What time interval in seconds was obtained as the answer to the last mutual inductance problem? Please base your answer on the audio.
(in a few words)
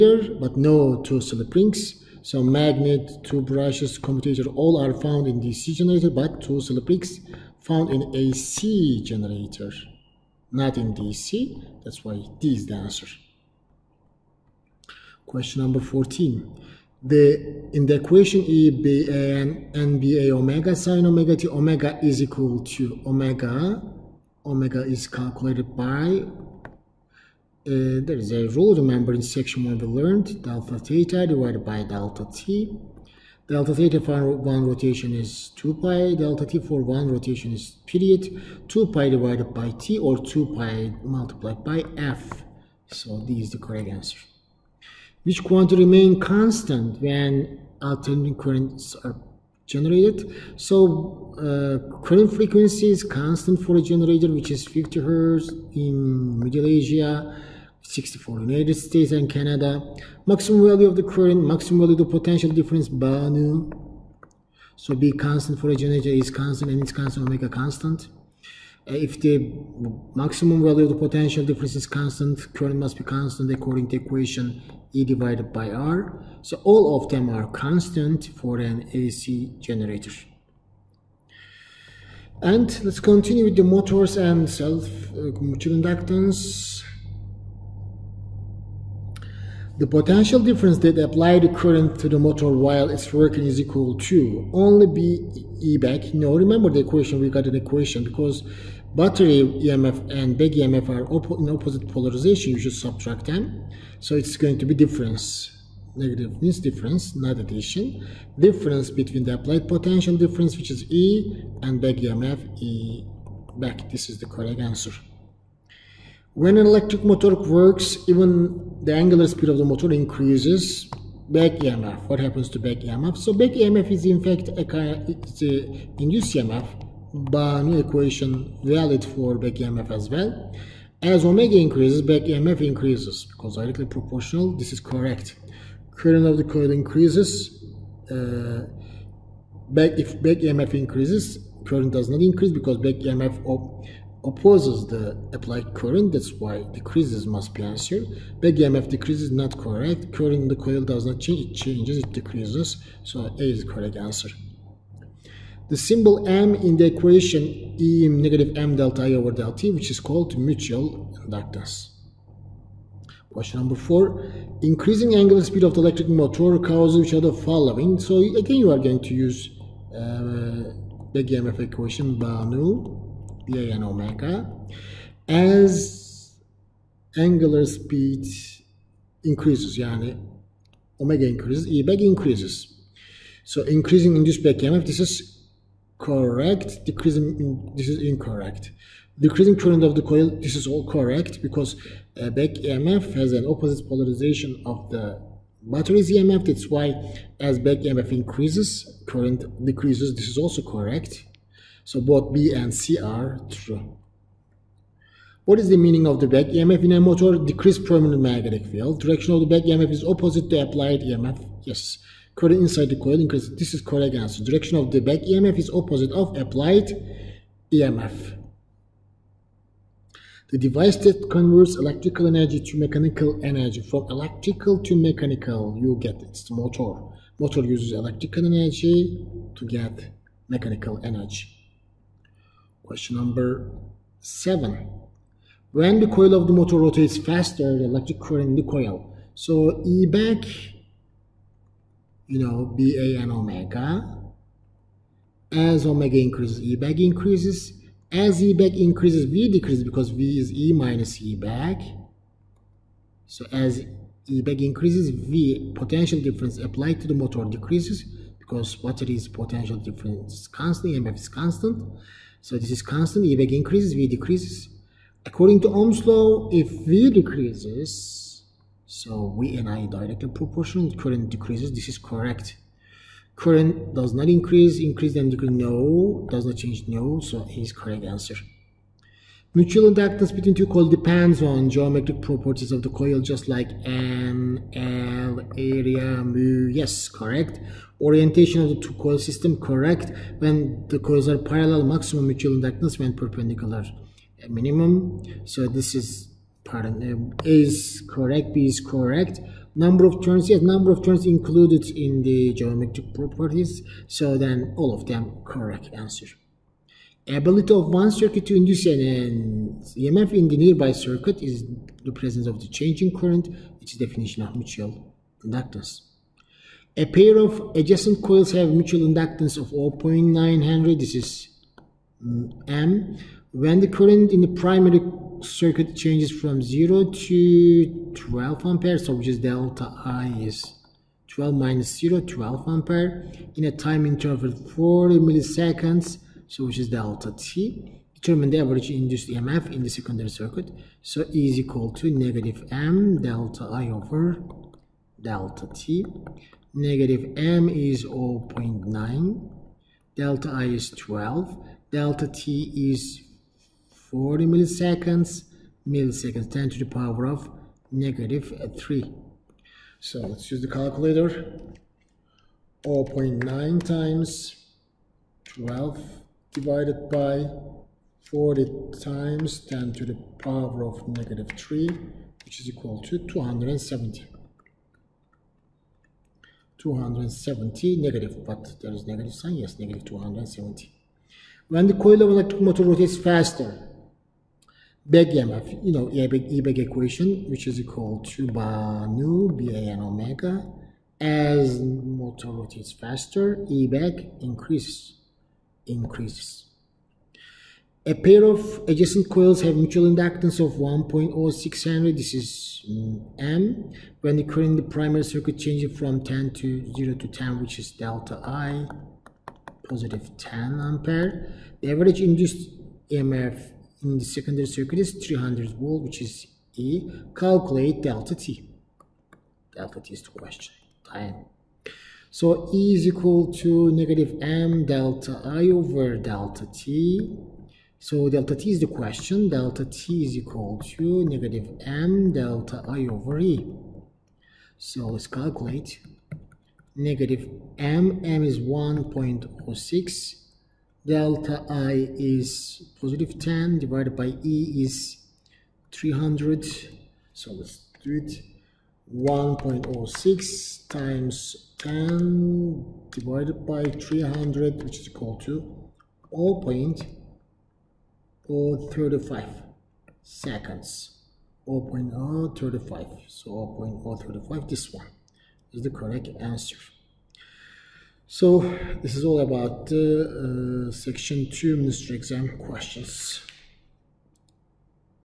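0.035 seconds.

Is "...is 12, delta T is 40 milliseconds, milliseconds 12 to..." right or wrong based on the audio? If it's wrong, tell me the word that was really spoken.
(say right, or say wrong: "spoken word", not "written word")
wrong: "10", not "12".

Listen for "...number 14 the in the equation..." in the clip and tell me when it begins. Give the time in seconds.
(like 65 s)
15 s.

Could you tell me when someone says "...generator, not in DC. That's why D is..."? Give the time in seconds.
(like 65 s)
9 s.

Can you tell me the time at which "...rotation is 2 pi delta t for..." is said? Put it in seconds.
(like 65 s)
34 s.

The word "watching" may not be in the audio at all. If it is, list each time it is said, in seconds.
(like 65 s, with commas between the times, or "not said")
not said.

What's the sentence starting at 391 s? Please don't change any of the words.
As motor rotates faster, e back increases increases.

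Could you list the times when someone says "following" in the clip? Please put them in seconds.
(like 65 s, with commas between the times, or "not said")
167 s.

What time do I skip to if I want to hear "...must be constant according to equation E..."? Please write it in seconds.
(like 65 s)
72 s.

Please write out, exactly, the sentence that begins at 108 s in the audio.
Difference between the applied potential difference, which is E, and back EMF, E back.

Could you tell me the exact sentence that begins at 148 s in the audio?
Back EMF decrease is not correct.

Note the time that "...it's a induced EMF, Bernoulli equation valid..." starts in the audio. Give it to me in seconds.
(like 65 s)
125 s.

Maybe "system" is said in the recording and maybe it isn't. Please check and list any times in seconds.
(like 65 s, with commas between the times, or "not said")
289 s.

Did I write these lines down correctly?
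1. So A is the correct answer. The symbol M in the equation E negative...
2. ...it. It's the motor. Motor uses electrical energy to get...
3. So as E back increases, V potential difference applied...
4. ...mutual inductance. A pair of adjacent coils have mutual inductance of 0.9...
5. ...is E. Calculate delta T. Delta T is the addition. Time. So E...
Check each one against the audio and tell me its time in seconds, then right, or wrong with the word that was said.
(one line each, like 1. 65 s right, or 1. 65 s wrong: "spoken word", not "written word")
1. 153 s right
2. 226 s right
3. 253 s right
4. 314 s right
5. 416 s wrong: "question", not "addition".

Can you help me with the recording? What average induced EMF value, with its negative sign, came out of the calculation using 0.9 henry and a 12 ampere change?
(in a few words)
-270.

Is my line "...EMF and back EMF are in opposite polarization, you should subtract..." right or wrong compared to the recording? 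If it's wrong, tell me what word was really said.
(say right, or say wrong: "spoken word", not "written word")
right.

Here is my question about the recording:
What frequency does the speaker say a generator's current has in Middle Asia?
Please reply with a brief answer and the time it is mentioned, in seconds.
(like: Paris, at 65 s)
50 hertz, at 54 s.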